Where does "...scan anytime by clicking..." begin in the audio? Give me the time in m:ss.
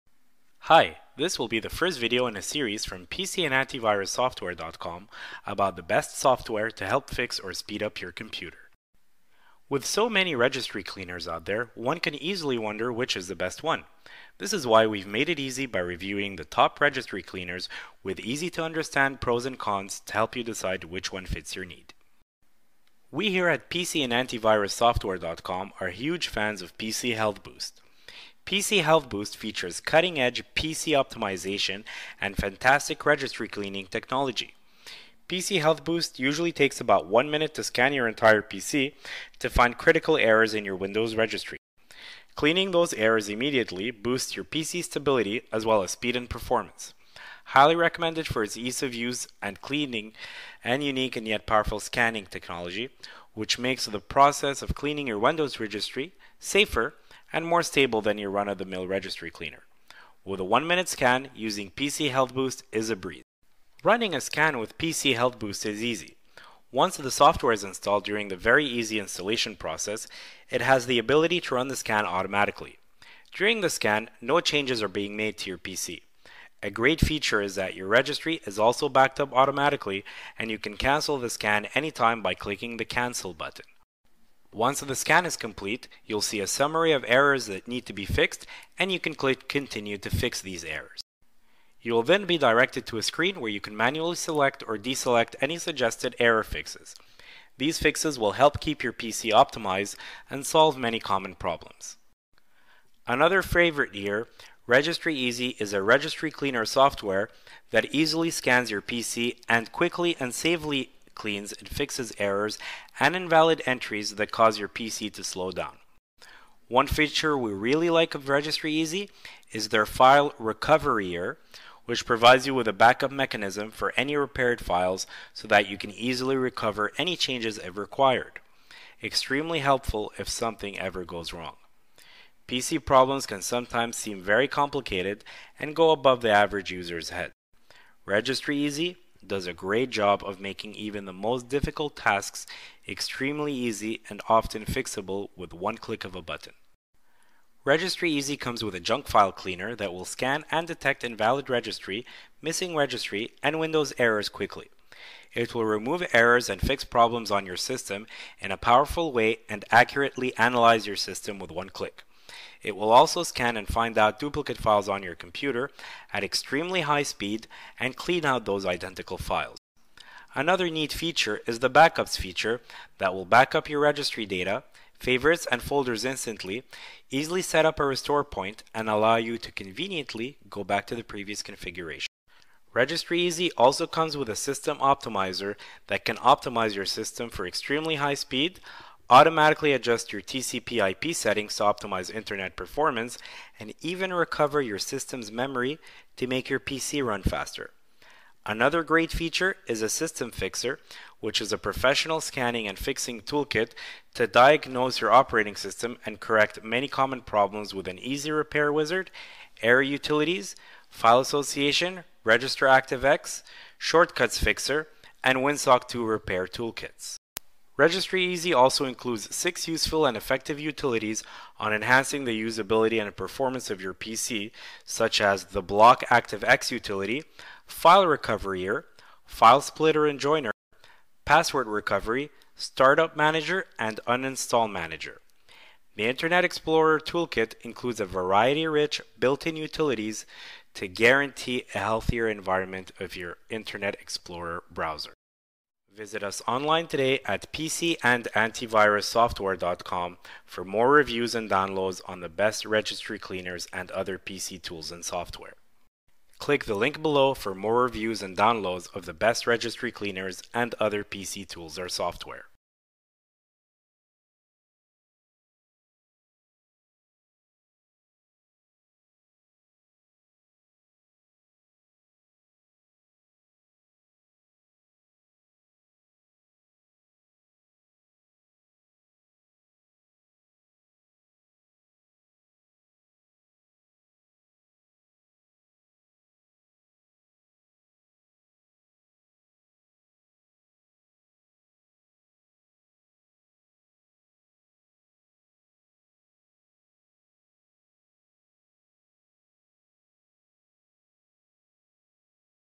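1:21.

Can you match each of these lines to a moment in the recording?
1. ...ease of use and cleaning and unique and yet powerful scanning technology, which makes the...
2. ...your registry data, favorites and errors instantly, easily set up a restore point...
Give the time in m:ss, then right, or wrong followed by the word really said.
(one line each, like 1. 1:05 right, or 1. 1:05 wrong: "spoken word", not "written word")
1. 0:48 right
2. 2:53 wrong: "folders", not "errors".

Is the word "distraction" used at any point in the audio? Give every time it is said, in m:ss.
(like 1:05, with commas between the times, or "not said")
not said.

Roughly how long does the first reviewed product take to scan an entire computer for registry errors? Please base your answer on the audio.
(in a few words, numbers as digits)
about one minute.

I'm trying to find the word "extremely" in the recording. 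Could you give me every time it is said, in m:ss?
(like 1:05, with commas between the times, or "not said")
2:09, 2:22, 2:46, 3:07.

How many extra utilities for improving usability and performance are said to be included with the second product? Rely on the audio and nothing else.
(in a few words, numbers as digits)
6.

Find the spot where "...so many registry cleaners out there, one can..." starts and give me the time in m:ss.
0:09.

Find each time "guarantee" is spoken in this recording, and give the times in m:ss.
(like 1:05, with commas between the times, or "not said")
4:00.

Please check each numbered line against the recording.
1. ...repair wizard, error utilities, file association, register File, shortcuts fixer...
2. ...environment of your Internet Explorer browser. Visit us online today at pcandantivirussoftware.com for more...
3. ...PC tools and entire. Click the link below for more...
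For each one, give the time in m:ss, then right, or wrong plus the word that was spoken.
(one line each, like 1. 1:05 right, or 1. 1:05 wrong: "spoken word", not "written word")
1. 3:28 wrong: "ActiveX", not "File"
2. 4:02 right
3. 4:14 wrong: "software", not "entire".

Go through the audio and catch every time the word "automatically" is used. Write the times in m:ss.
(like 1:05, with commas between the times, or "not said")
1:12, 1:19, 3:09.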